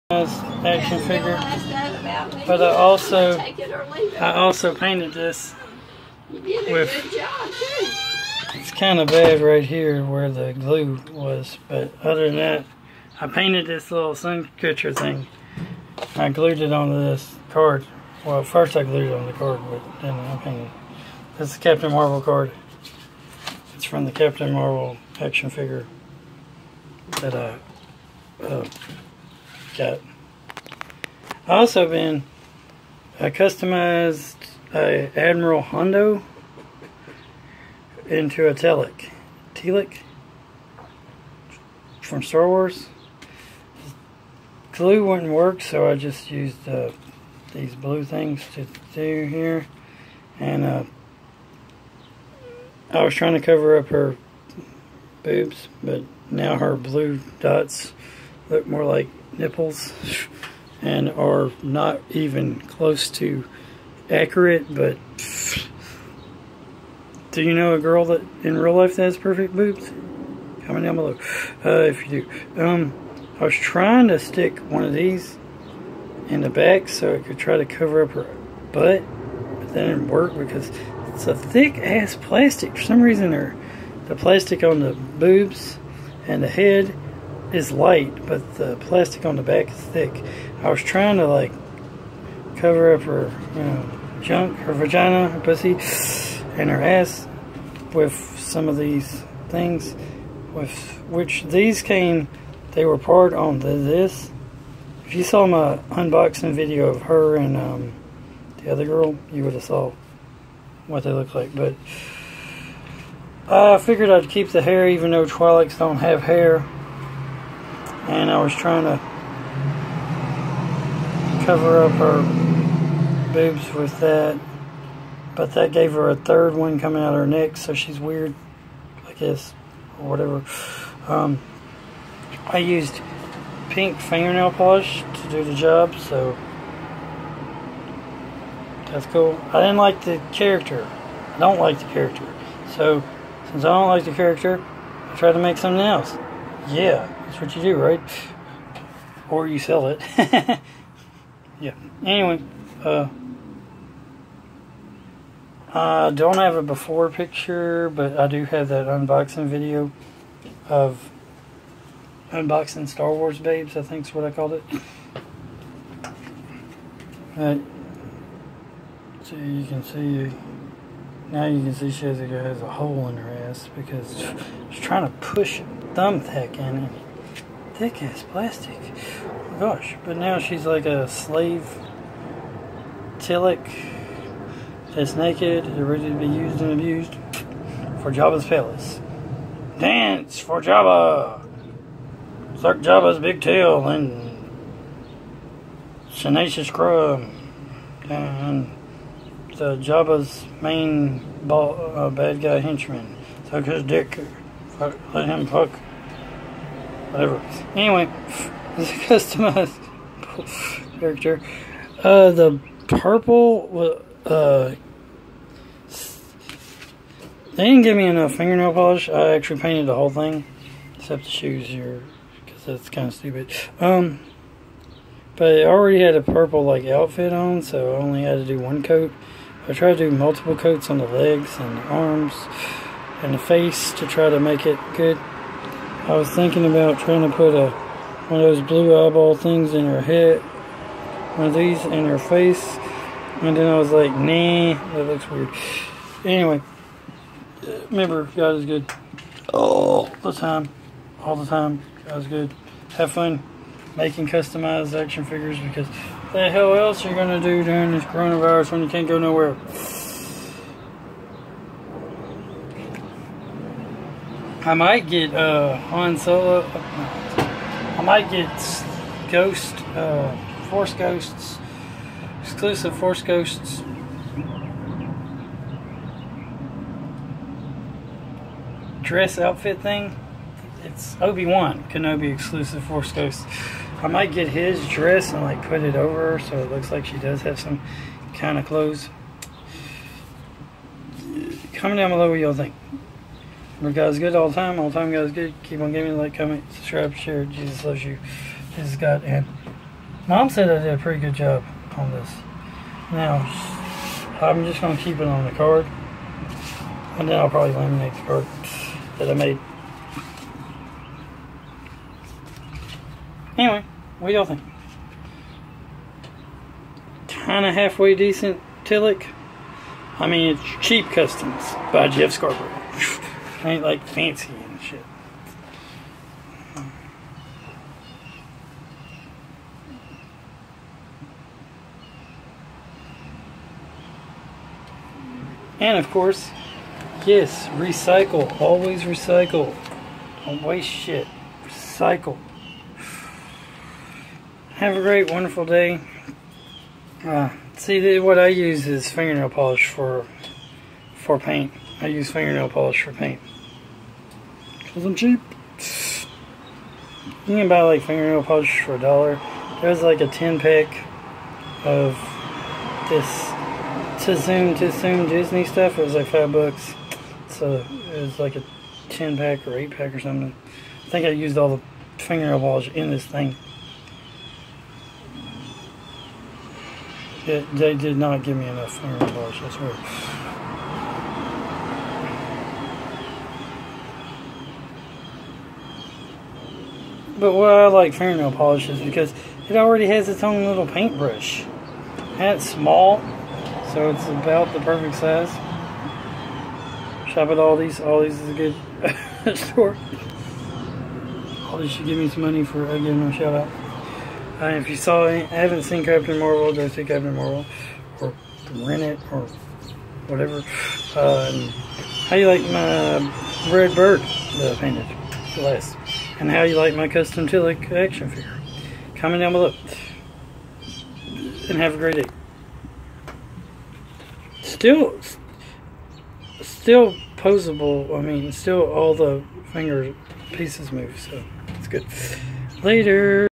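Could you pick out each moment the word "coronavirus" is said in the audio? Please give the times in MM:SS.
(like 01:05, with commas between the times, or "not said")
04:18.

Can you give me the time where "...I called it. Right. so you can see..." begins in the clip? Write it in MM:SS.
02:44.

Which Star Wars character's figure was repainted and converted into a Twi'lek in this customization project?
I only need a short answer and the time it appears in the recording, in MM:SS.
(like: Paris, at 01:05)
Admiral Holdo, at 00:35.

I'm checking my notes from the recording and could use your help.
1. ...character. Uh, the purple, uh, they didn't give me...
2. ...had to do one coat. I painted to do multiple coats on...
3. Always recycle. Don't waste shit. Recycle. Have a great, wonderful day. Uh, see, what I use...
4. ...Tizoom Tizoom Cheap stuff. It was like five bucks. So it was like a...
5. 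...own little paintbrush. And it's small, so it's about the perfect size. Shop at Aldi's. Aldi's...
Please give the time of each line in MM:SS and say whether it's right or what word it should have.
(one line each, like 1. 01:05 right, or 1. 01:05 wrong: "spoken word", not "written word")
1. 03:30 right
2. 03:48 wrong: "tried", not "painted"
3. 05:38 right
4. 06:04 wrong: "Disney", not "Cheap"
5. 06:30 right.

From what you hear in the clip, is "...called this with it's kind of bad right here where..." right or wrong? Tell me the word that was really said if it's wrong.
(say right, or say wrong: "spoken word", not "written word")
wrong: "painted", not "called".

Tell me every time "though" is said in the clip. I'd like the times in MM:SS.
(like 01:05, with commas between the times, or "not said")
01:55.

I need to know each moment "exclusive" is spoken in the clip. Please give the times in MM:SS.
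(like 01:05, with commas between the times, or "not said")
04:32, 04:42.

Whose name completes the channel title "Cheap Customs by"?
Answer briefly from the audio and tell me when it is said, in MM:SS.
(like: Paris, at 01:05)
Jeff Scarbrough, at 05:22.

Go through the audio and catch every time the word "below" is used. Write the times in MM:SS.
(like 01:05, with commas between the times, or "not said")
01:10, 04:52, 06:59.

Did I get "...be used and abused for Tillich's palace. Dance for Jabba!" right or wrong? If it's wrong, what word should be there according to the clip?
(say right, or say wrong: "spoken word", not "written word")
wrong: "Jabba", not "Tillich".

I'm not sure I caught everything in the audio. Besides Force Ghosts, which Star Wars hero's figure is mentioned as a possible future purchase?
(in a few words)
Han Solo.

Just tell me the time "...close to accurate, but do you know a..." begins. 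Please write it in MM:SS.
01:02.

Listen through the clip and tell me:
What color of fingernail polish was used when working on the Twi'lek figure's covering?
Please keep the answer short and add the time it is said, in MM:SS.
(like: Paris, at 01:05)
Pink, at 02:13.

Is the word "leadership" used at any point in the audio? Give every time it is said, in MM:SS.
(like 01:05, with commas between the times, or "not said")
not said.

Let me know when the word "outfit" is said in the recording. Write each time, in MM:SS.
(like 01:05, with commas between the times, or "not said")
03:46, 04:39.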